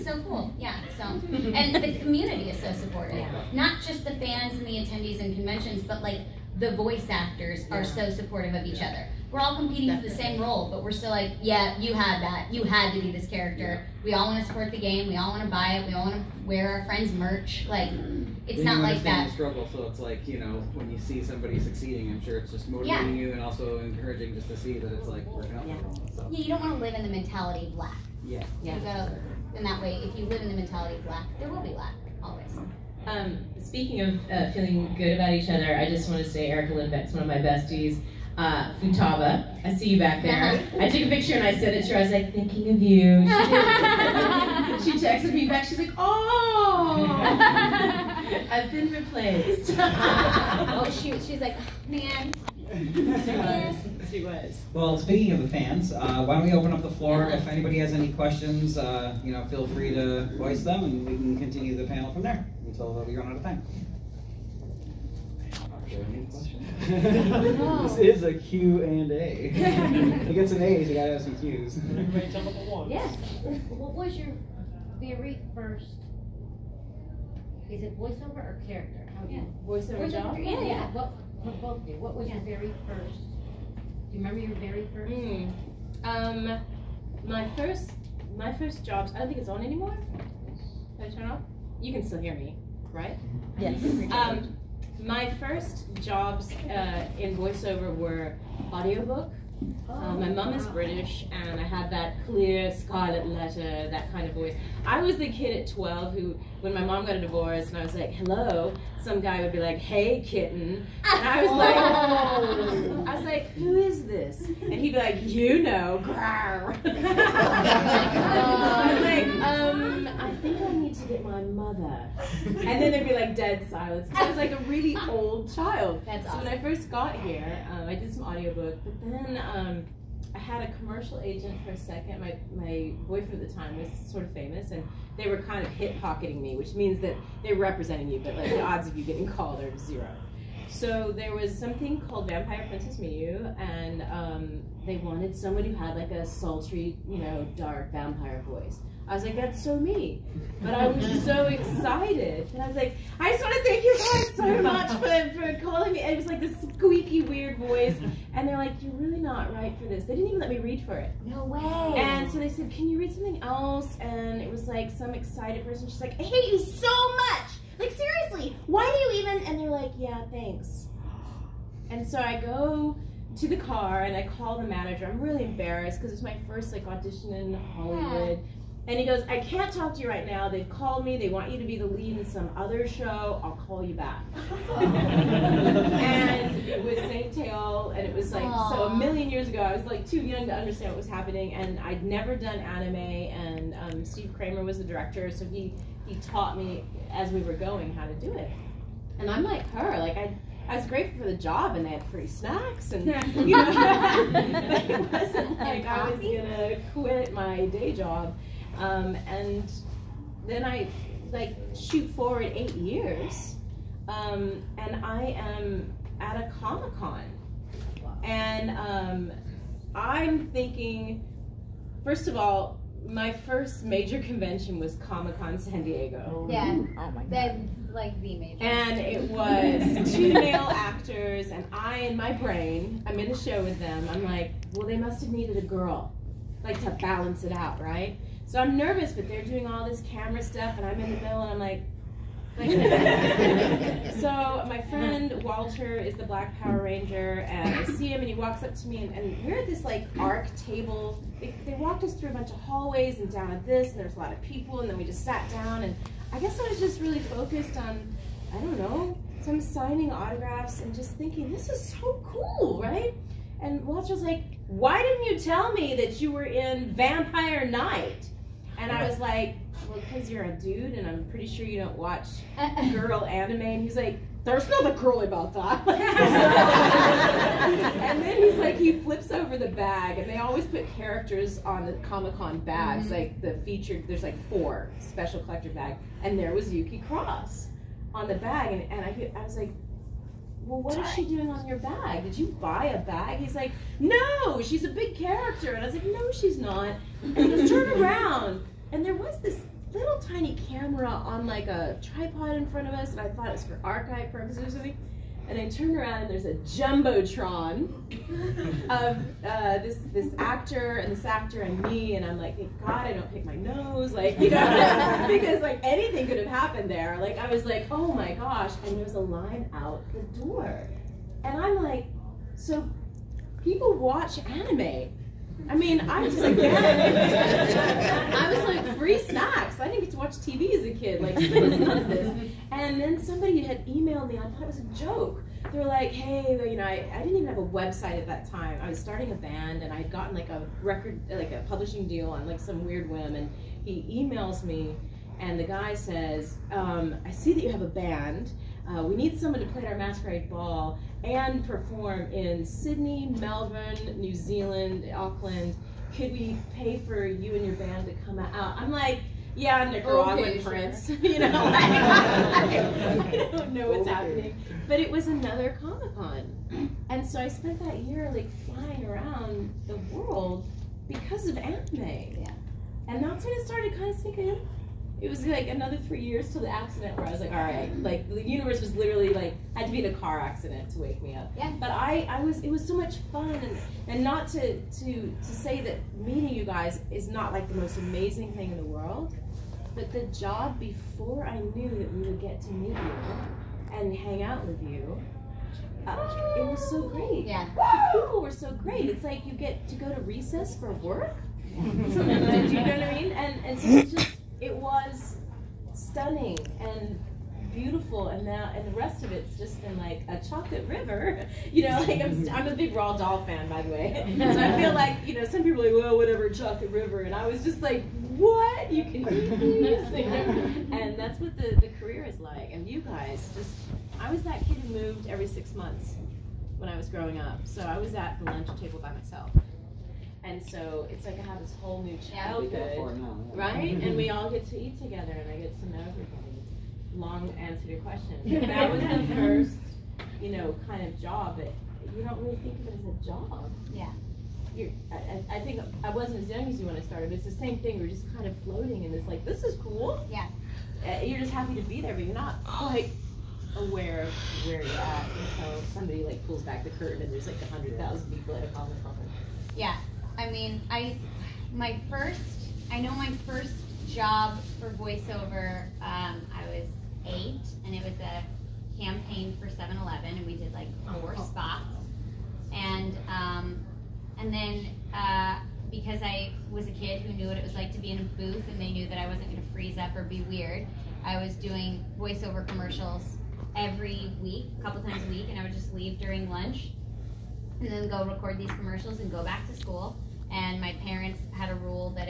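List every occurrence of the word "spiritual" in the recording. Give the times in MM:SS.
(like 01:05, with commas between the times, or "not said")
not said.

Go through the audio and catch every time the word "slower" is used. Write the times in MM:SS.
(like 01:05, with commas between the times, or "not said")
not said.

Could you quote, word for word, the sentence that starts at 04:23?
And Walter's like, why didn't you tell me that you were in Vampire Knight?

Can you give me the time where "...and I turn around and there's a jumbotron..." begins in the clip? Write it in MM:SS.
05:05.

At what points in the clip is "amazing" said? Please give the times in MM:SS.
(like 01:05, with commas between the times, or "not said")
06:27.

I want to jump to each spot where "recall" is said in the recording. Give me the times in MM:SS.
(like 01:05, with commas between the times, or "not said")
not said.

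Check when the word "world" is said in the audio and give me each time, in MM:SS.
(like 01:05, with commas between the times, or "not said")
06:10, 06:28.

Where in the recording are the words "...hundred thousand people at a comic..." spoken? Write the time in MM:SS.
07:37.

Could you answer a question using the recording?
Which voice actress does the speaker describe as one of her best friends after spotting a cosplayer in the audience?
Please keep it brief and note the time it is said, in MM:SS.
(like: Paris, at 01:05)
Erica Lindbeck, at 00:36.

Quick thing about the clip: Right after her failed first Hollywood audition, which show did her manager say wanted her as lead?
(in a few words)
St. Tail.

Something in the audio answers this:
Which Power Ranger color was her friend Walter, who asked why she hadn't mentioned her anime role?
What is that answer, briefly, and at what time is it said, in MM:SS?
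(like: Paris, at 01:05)
Black, at 04:06.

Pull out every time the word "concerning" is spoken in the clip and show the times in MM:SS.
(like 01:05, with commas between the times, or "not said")
not said.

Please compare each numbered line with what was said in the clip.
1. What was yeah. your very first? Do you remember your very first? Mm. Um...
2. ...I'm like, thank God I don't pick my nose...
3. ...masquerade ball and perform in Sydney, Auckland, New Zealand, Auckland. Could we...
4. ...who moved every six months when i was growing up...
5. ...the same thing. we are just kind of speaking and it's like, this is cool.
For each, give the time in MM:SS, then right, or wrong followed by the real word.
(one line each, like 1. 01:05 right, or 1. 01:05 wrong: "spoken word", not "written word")
1. 01:21 right
2. 05:12 right
3. 05:49 wrong: "Melbourne", not "Auckland"
4. 07:04 right
5. 07:27 wrong: "floating", not "speaking".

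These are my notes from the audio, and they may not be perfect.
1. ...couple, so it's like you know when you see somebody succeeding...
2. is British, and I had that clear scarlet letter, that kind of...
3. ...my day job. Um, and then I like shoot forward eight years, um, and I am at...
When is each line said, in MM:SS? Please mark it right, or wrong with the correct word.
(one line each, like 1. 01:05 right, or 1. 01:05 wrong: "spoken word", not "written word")
1. 00:19 wrong: "struggle", not "couple"
2. 01:40 right
3. 03:27 right.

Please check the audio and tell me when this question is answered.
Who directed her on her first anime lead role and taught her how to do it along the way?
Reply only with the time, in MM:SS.
03:14.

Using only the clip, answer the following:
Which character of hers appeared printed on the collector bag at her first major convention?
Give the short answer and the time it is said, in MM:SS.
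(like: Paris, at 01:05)
Yuki Cross, at 04:46.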